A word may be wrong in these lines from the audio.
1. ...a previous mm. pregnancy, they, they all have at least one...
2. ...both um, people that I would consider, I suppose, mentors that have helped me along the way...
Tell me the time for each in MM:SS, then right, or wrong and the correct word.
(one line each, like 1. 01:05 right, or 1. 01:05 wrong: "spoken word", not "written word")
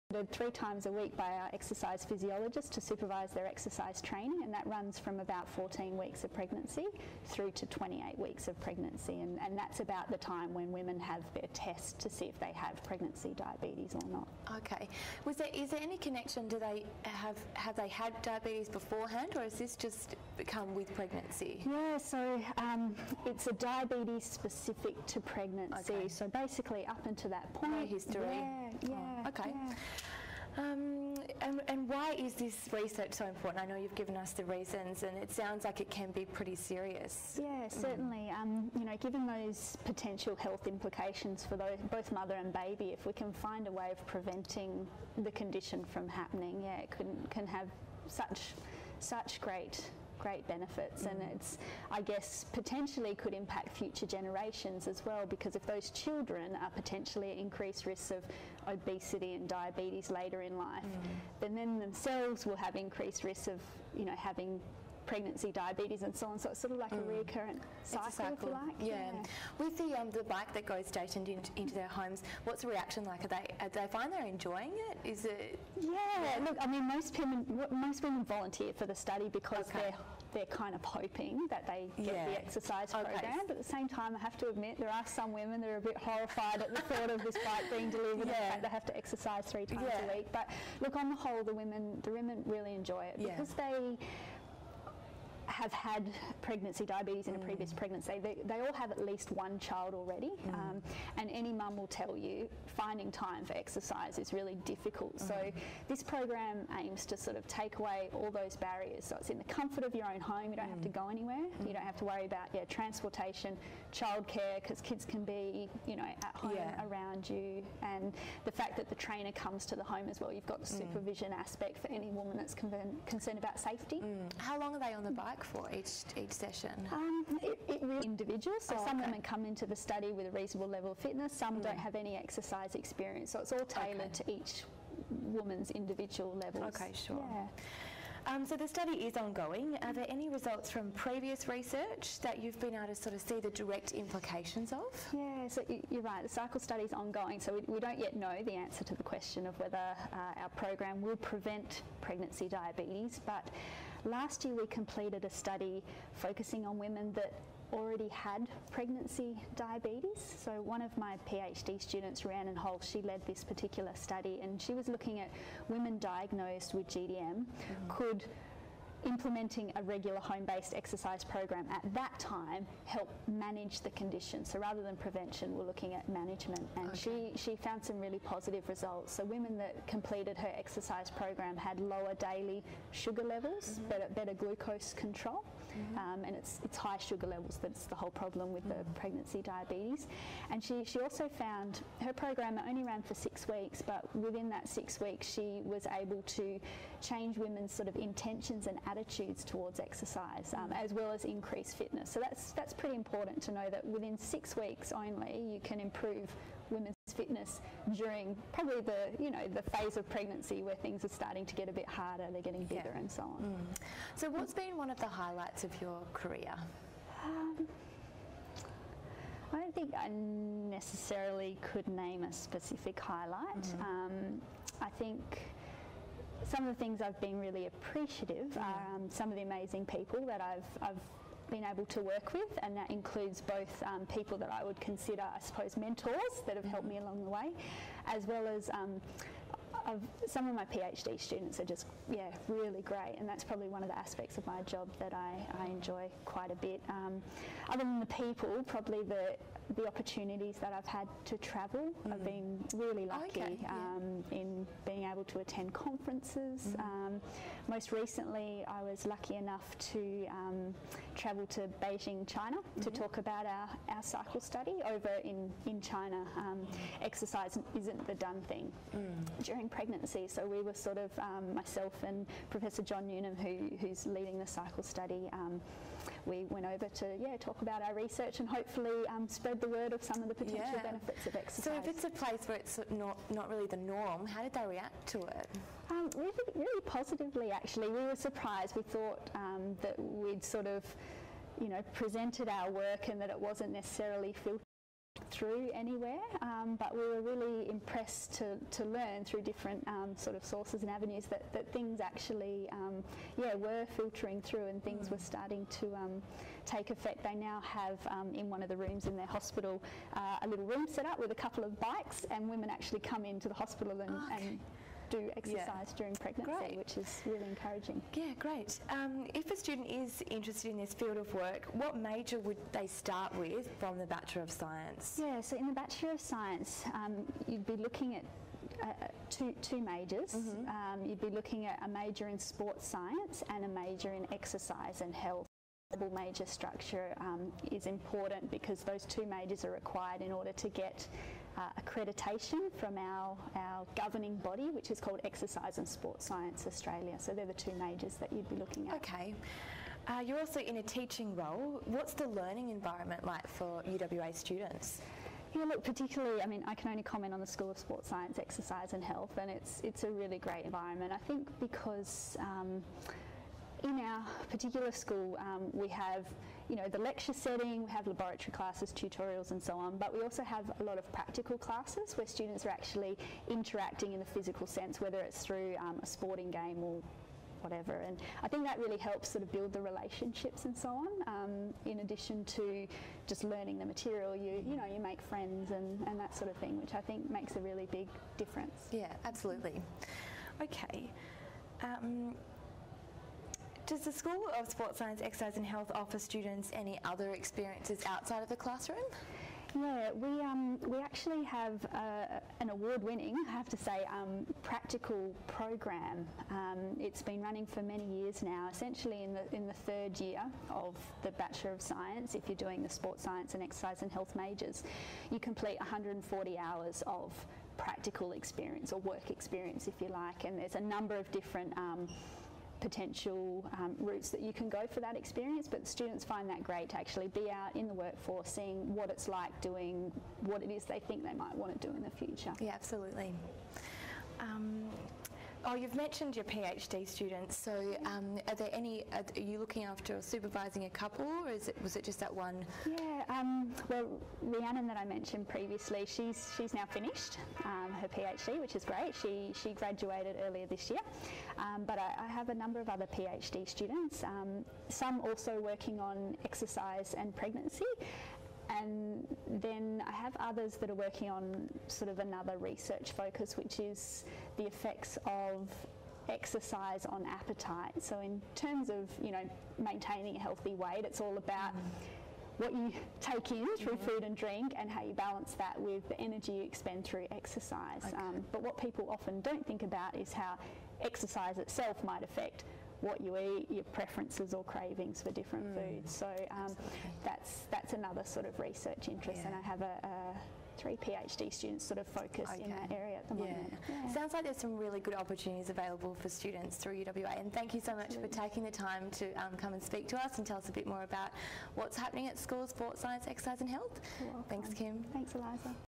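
1. 01:37 right
2. 03:53 right.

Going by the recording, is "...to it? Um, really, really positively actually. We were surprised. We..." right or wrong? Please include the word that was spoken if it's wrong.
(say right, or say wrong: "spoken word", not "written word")
right.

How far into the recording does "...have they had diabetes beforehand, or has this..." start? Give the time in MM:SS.
00:17.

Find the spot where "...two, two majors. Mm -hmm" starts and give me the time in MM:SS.
05:29.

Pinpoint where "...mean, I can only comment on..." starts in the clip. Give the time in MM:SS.
05:56.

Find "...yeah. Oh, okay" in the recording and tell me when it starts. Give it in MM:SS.
00:28.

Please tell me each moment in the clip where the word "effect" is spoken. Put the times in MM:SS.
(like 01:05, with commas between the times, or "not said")
05:06, 07:44.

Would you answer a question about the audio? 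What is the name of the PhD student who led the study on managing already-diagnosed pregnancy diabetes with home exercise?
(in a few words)
Rhiannon Holt.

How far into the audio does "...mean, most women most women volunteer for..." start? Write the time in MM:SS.
01:16.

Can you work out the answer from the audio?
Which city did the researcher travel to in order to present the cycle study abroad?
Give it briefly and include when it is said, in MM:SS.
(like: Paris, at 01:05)
Beijing, at 04:21.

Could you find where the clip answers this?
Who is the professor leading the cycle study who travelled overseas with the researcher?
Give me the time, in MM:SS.
04:32.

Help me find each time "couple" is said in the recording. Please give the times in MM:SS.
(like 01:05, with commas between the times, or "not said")
05:11, 07:20.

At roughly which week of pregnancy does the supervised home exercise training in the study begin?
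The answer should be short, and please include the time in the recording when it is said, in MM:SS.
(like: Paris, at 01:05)
14 weeks, at 00:05.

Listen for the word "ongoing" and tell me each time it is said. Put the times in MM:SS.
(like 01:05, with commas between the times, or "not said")
02:19, 02:26.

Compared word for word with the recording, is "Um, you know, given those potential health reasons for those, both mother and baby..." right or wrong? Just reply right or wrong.
wrong.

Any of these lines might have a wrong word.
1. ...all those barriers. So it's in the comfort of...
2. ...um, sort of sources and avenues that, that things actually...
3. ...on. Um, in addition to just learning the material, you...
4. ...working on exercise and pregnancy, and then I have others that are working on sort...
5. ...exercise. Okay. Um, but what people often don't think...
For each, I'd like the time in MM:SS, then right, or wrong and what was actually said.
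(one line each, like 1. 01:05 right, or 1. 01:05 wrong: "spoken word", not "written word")
1. 01:48 right
2. 04:59 right
3. 06:20 right
4. 07:35 right
5. 07:57 right.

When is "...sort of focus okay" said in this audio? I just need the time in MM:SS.
08:11.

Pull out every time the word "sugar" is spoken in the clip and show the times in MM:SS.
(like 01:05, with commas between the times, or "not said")
03:02, 03:06.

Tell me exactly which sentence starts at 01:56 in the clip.
around you, and the fact that the trainer comes to the home as well.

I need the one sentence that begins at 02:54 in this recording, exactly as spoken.
So rather than prevention, we're looking at management.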